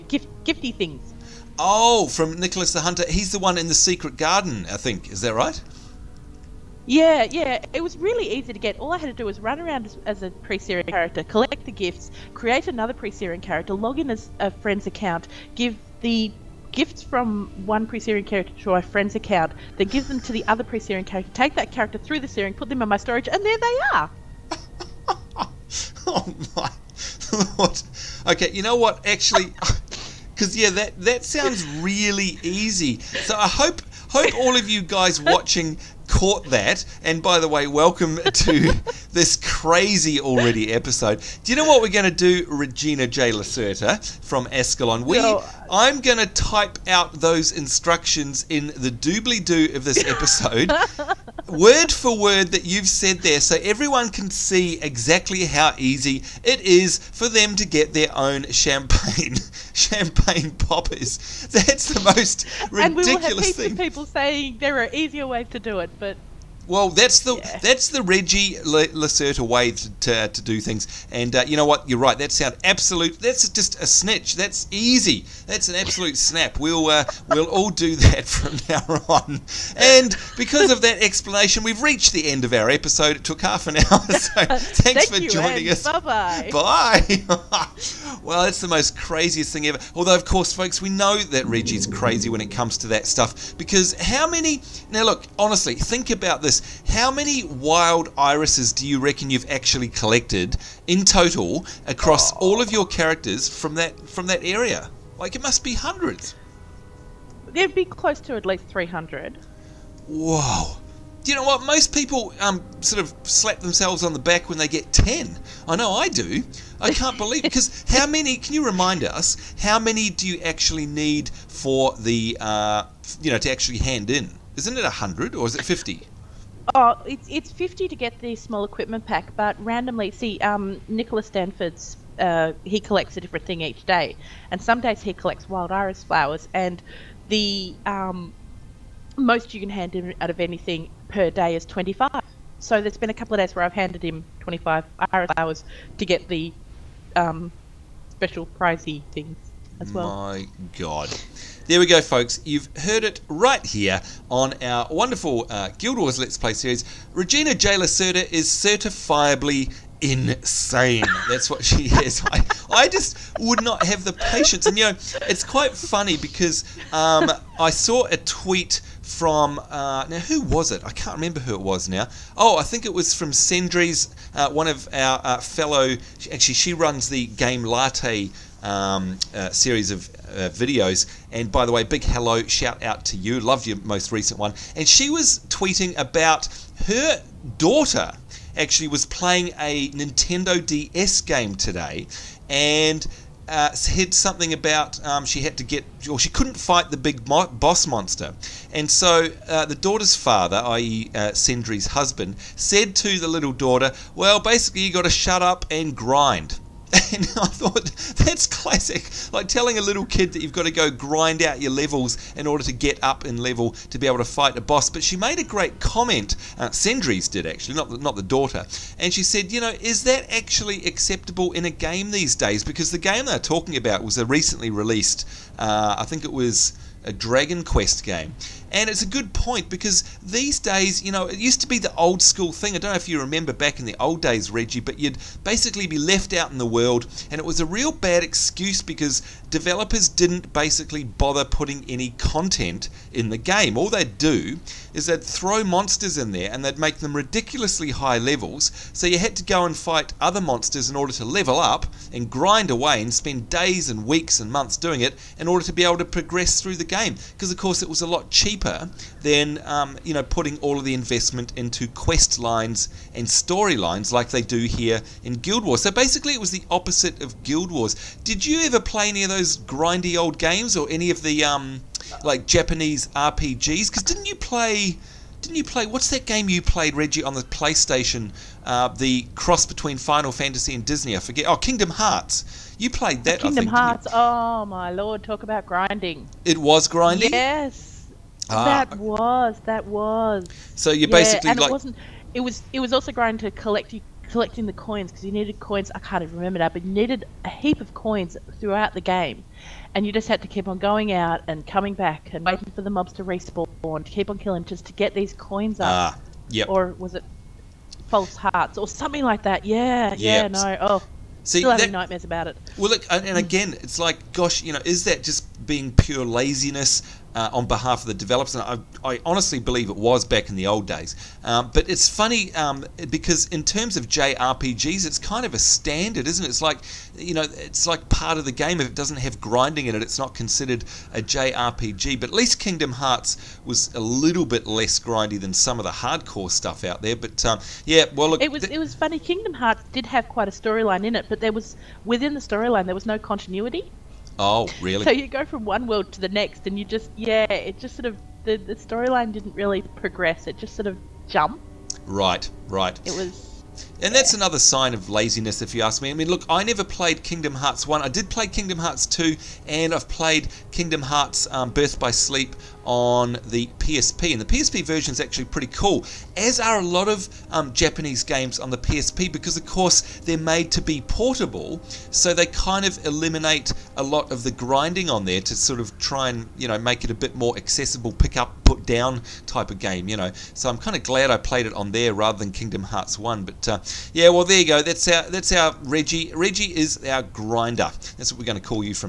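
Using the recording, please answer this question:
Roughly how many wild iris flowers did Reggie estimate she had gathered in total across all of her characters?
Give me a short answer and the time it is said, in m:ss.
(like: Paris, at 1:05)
300, at 1:48.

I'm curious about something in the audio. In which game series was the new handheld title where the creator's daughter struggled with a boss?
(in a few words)
Dragon Quest.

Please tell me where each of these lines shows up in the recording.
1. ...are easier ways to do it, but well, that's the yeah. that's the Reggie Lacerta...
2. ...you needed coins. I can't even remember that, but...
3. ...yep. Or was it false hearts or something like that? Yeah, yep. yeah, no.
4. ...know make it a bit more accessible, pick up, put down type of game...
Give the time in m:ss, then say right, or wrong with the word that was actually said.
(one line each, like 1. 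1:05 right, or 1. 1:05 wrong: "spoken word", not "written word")
1. 1:04 right
2. 4:55 right
3. 5:06 right
4. 6:16 right.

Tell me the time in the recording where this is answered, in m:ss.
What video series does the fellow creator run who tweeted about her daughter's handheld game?
2:57.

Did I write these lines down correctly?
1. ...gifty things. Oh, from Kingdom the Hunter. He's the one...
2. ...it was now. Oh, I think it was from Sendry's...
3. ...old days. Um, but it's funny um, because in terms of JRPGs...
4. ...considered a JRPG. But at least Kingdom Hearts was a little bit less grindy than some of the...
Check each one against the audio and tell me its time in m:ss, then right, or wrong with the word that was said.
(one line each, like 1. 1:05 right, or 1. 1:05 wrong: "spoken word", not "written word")
1. 0:00 wrong: "Nicholas", not "Kingdom"
2. 2:51 right
3. 5:20 right
4. 5:30 right.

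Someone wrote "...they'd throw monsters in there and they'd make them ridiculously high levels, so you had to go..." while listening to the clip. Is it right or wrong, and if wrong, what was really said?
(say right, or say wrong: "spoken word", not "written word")
right.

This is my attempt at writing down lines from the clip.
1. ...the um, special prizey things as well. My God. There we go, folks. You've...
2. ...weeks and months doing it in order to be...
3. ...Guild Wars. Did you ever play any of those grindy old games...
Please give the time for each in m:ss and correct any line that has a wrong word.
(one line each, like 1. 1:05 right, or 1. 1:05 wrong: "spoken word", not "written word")
1. 2:26 right
2. 4:14 right
3. 4:27 right.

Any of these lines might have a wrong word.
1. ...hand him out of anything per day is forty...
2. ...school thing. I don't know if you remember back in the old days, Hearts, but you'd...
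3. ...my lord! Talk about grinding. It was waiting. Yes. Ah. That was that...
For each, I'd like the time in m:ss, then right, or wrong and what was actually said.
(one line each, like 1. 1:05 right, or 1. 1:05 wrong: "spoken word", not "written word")
1. 2:19 wrong: "twenty", not "forty"
2. 3:52 wrong: "Reggie", not "Hearts"
3. 4:44 wrong: "grinding", not "waiting".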